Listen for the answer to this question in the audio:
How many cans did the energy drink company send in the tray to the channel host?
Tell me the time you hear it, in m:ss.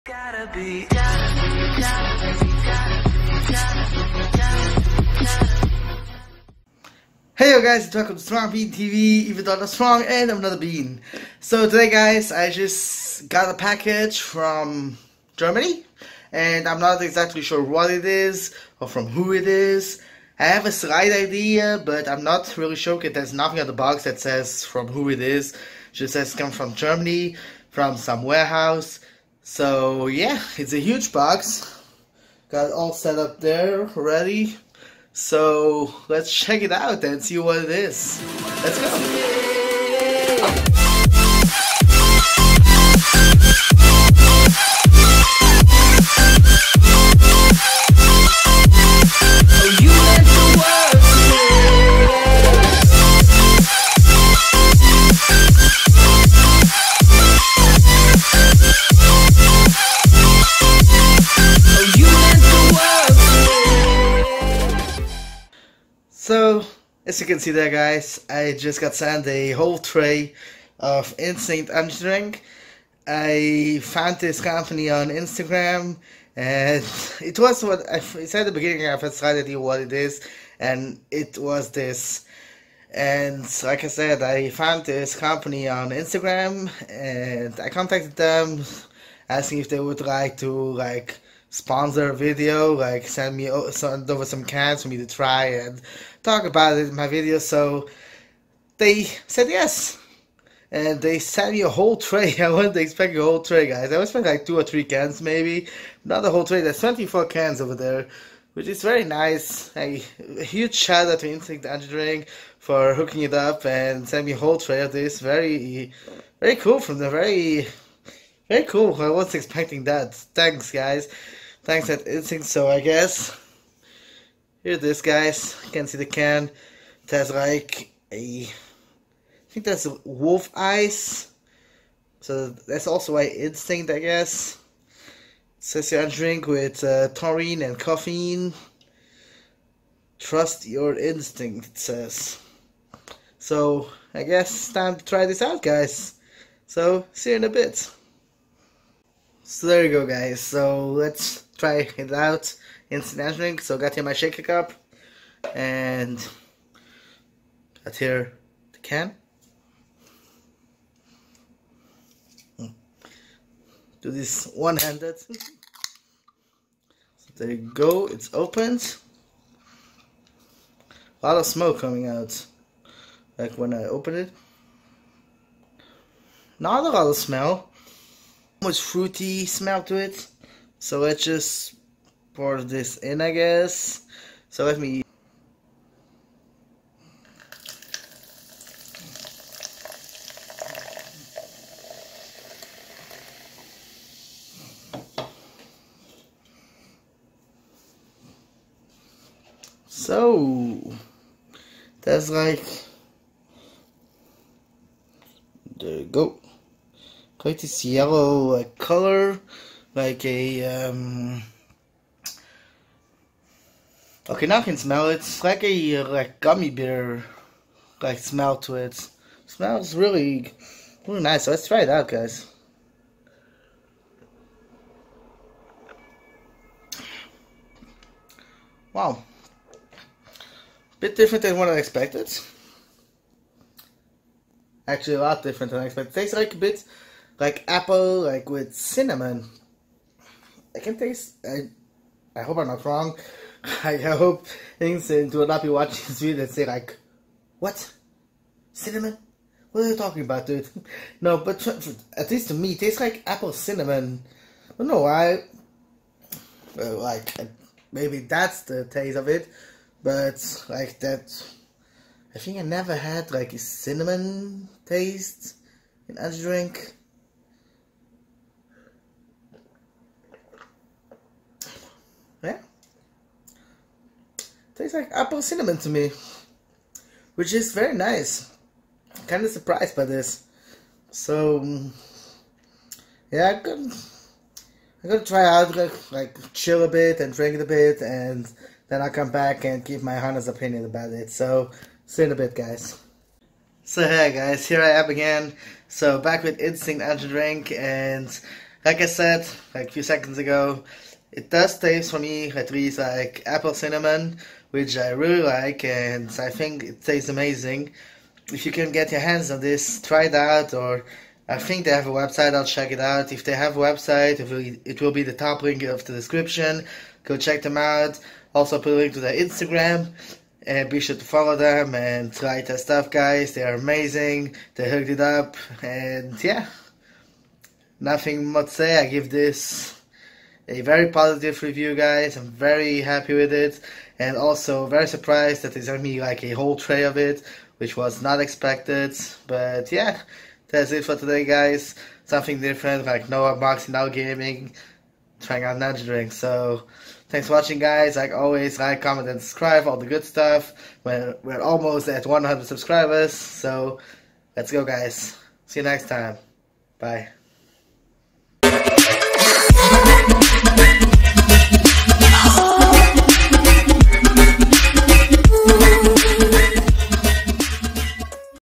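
1:46.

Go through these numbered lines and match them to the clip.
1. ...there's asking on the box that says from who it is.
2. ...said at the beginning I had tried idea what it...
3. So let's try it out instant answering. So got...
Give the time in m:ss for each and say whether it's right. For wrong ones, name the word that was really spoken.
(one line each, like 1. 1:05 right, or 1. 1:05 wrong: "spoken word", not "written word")
1. 0:23 wrong: "nothing", not "asking"
2. 1:17 right
3. 2:30 right.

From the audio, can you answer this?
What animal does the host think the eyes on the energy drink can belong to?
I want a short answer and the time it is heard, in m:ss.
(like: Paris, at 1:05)
Wolf, at 2:10.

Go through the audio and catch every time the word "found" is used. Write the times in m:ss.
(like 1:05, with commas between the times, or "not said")
1:13, 1:24.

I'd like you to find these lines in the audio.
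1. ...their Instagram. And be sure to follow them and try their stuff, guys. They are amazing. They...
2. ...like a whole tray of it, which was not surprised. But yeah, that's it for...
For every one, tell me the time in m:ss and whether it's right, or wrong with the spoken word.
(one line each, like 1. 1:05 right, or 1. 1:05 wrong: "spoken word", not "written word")
1. 5:19 right
2. 5:36 wrong: "expected", not "surprised".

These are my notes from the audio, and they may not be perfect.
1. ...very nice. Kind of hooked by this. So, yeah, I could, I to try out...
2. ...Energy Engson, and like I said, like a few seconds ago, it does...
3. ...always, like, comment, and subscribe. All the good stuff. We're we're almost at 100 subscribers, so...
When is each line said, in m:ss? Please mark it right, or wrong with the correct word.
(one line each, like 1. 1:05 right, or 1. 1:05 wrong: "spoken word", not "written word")
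1. 4:37 wrong: "surprised", not "hooked"
2. 4:57 wrong: "Drink", not "Engson"
3. 5:48 right.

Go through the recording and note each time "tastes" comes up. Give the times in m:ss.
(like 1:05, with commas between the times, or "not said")
3:56, 4:00, 4:12, 4:18, 4:24, 4:34, 5:01, 5:07.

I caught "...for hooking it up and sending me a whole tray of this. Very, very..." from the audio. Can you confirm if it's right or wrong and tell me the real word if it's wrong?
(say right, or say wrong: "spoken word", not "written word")
right.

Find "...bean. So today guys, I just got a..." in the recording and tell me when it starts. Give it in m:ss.
0:10.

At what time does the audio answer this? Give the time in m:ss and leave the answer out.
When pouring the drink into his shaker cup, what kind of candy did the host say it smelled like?
3:36.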